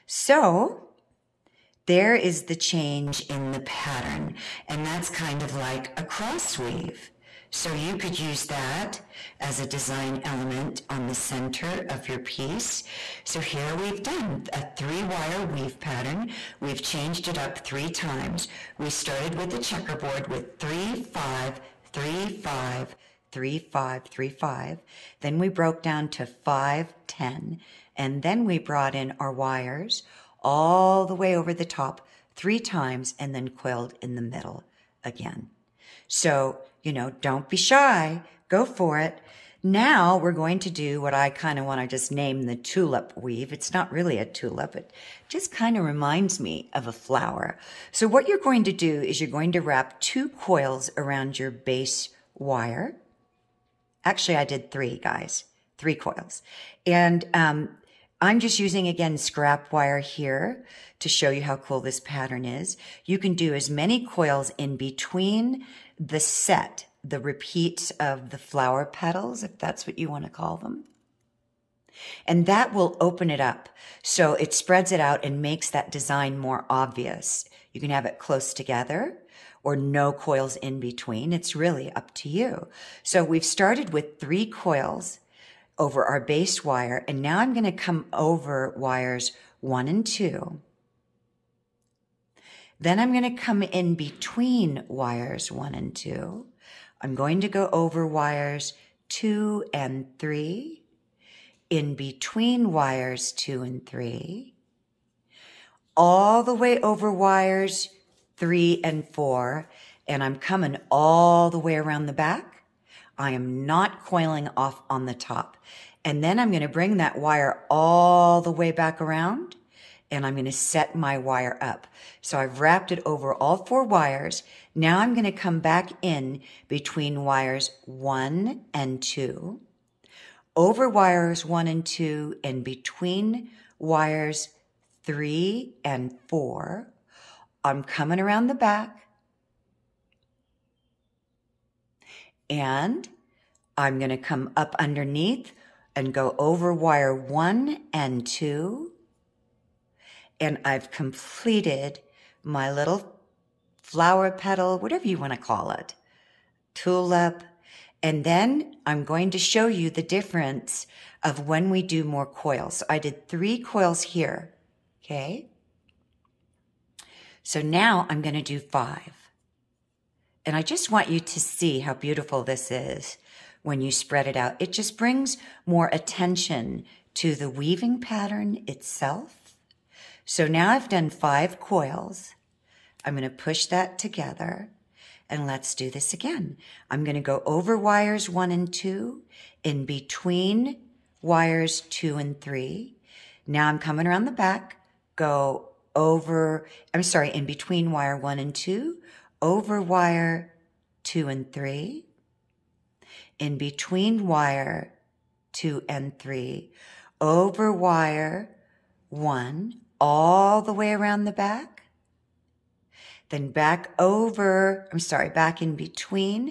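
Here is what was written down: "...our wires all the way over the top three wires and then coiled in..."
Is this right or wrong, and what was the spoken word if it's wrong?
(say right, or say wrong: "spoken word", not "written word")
wrong: "times", not "wires".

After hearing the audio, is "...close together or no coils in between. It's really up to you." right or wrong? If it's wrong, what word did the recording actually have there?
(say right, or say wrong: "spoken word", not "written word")
right.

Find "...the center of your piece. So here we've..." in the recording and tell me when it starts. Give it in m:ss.
0:11.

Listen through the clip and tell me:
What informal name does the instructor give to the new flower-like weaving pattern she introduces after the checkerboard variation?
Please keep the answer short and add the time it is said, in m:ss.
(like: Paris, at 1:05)
tulip weave, at 0:42.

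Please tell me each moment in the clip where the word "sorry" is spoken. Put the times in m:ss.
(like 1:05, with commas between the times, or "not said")
3:17, 3:34.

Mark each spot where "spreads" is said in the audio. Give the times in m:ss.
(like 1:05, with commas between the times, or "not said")
1:14, 2:53.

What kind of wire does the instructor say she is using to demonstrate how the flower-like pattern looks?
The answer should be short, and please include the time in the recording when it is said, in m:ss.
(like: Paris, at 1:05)
scrap wire, at 0:59.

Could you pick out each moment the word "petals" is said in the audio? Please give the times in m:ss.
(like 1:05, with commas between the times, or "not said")
1:08, 2:34.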